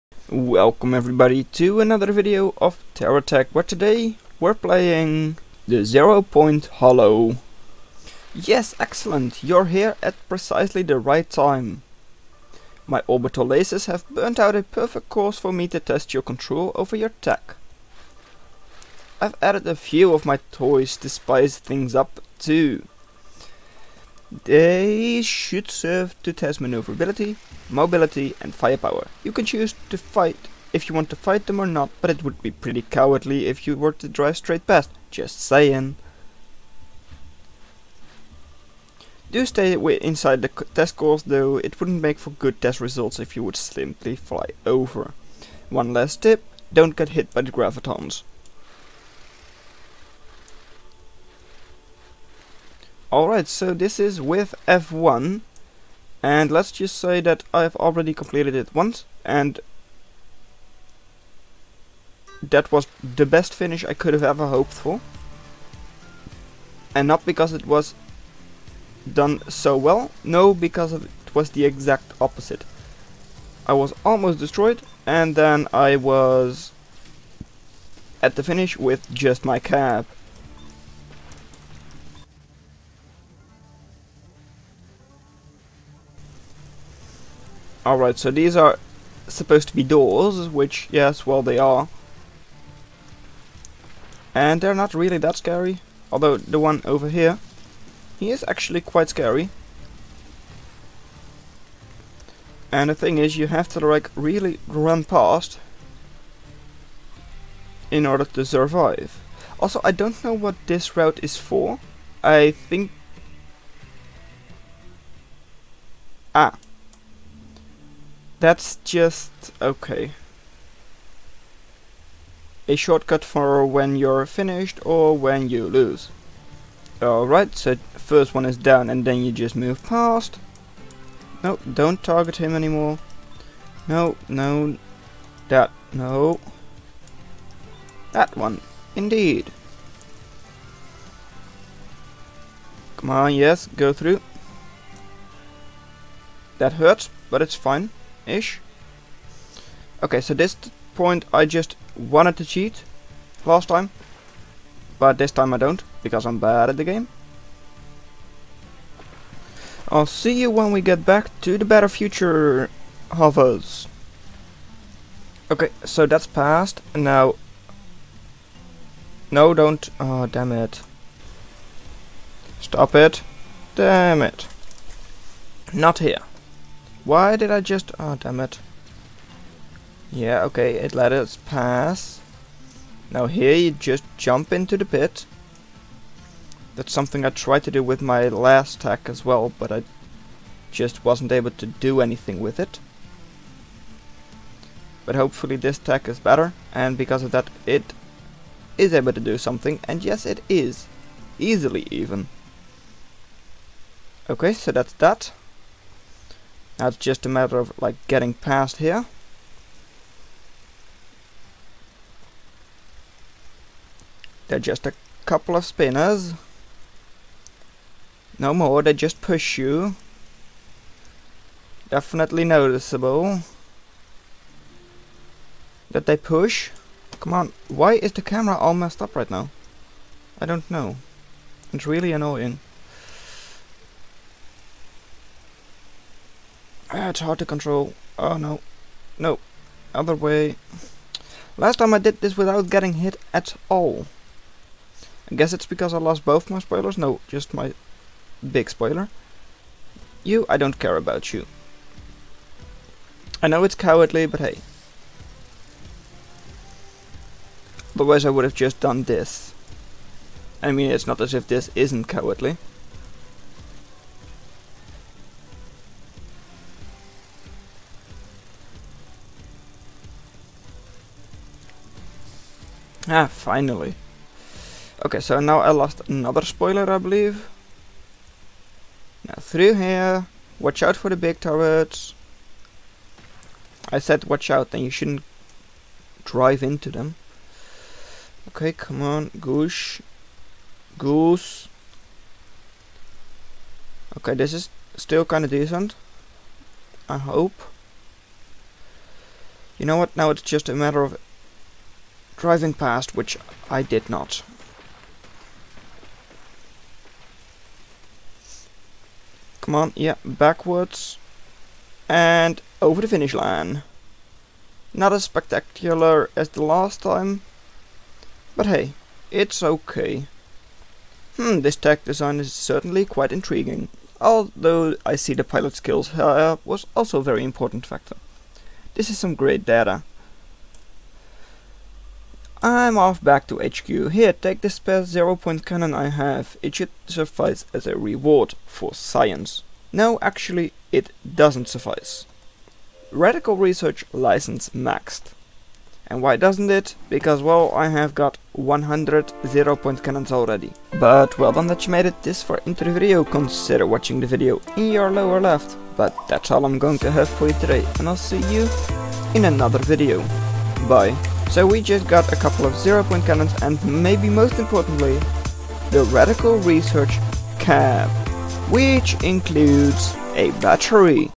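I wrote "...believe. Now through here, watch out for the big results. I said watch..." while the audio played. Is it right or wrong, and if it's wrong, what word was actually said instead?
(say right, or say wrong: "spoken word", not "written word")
wrong: "turrets", not "results".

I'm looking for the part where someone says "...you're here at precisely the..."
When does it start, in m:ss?
0:09.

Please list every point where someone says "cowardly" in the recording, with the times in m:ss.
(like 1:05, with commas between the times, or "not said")
0:32, 4:13, 4:22.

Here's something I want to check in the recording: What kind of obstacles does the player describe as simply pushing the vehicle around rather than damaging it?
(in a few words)
Spinners.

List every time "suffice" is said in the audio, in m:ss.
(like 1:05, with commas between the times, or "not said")
5:37, 5:41.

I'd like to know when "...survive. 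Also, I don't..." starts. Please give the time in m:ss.
1:48.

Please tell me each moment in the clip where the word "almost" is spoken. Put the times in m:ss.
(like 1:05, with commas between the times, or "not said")
1:14.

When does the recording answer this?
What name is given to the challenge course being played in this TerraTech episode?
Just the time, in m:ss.
0:05.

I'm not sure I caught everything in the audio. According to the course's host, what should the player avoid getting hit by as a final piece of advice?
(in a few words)
The gravitons.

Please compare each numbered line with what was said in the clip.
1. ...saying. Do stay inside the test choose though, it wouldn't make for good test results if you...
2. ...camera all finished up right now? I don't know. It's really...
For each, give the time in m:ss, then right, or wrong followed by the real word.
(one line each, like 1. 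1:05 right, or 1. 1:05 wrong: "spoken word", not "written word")
1. 0:35 wrong: "course", not "choose"
2. 3:48 wrong: "messed", not "finished".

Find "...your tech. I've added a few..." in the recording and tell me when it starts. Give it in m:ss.
0:16.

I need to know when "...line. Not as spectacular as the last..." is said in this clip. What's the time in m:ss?
5:13.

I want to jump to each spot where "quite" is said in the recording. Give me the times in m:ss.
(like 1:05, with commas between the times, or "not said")
1:38, 5:23.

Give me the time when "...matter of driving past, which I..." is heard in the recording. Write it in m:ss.
5:00.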